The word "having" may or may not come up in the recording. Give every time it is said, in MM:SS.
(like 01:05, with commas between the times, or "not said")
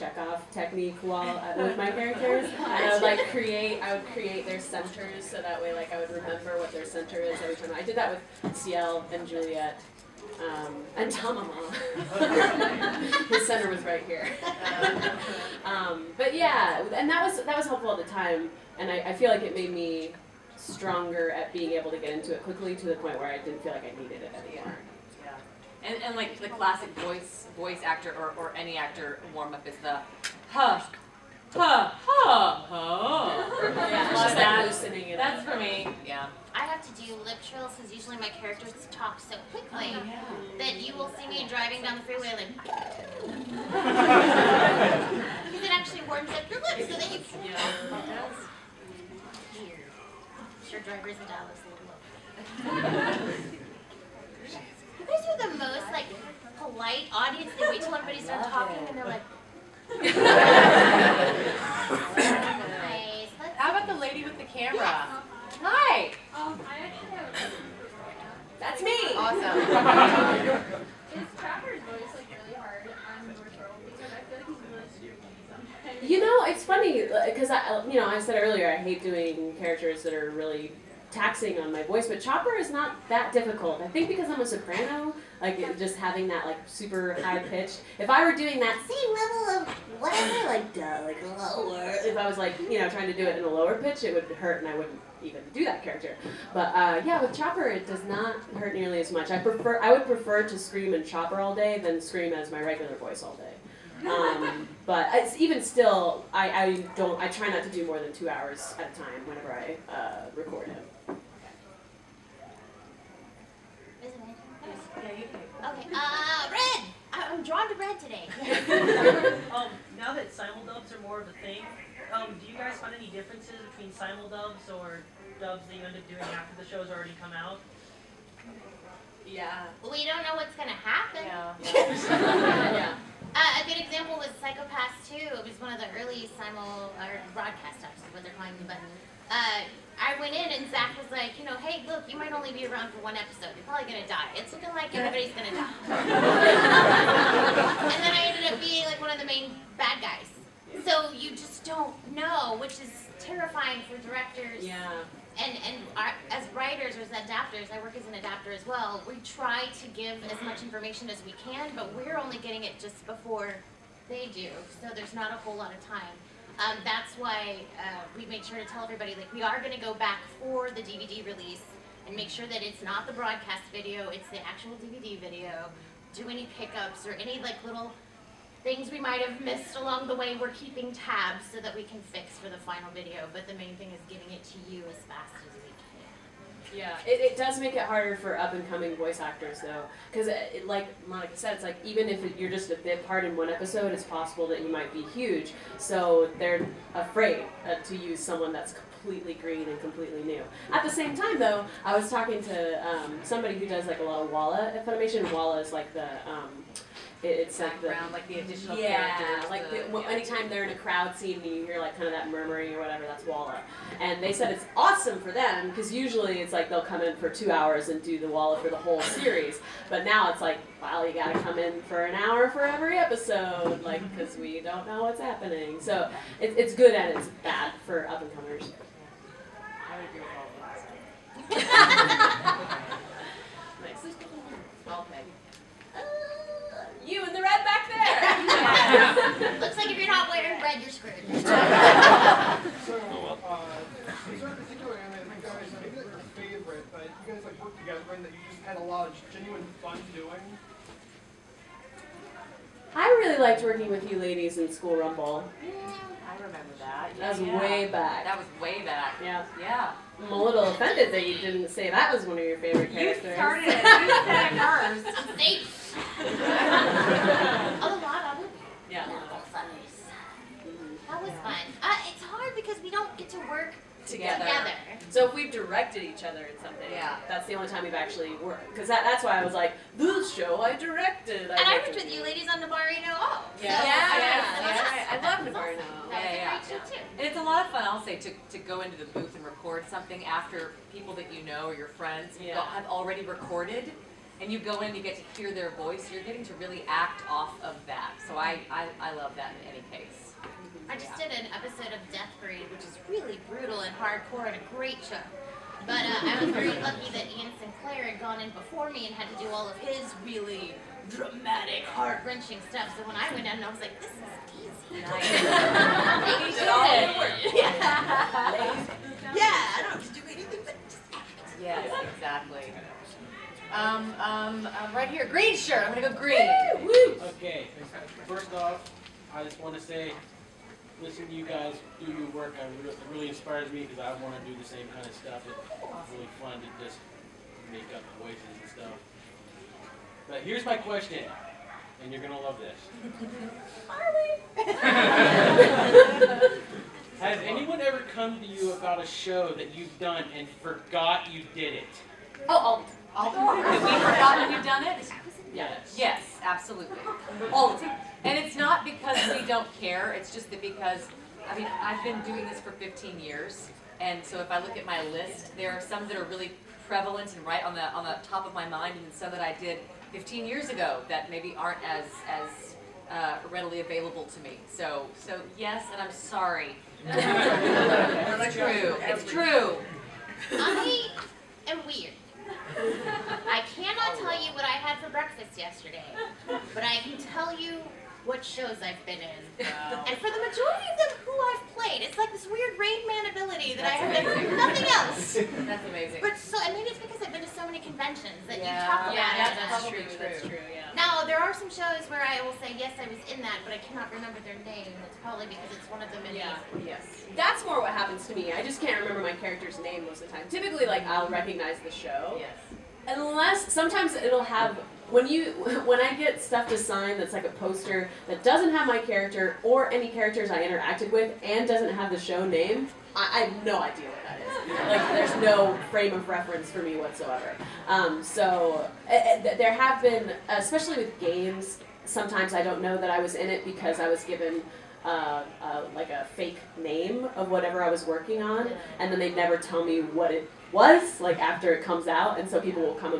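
01:25.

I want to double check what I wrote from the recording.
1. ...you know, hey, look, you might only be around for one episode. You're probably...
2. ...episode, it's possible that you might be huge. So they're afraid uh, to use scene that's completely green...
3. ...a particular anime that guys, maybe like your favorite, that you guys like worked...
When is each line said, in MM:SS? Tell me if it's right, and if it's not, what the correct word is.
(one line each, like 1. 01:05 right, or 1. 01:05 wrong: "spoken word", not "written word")
1. 02:21 right
2. 03:13 wrong: "someone", not "scene"
3. 04:04 right.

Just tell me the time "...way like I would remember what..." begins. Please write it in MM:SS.
00:05.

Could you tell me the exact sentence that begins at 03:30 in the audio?
anytime they're in a crowd scene and you hear like kind of that murmuring or whatever, that's Walla.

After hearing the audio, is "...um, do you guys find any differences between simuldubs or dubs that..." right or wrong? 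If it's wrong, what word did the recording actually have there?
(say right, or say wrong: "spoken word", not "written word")
right.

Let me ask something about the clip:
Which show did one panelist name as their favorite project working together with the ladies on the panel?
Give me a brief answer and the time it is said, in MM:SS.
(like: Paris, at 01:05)
School Rumble, at 04:14.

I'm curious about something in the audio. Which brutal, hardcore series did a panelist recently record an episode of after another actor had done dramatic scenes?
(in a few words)
Death Parade.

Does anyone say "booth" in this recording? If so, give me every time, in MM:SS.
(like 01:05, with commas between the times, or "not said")
04:49.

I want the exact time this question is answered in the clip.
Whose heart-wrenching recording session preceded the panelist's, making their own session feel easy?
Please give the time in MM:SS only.
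05:07.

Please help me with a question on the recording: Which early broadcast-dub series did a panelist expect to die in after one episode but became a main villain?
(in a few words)
Psycho-Pass 2.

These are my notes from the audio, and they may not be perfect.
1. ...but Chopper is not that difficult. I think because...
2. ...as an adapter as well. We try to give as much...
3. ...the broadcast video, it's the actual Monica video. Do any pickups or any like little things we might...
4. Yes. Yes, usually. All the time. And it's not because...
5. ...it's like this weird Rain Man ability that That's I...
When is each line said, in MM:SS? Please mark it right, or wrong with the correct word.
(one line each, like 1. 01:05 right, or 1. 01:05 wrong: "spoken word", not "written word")
1. 01:22 right
2. 02:37 right
3. 02:53 wrong: "DVD", not "Monica"
4. 05:55 wrong: "absolutely", not "usually"
5. 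06:32 right.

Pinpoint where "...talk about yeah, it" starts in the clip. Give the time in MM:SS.
06:38.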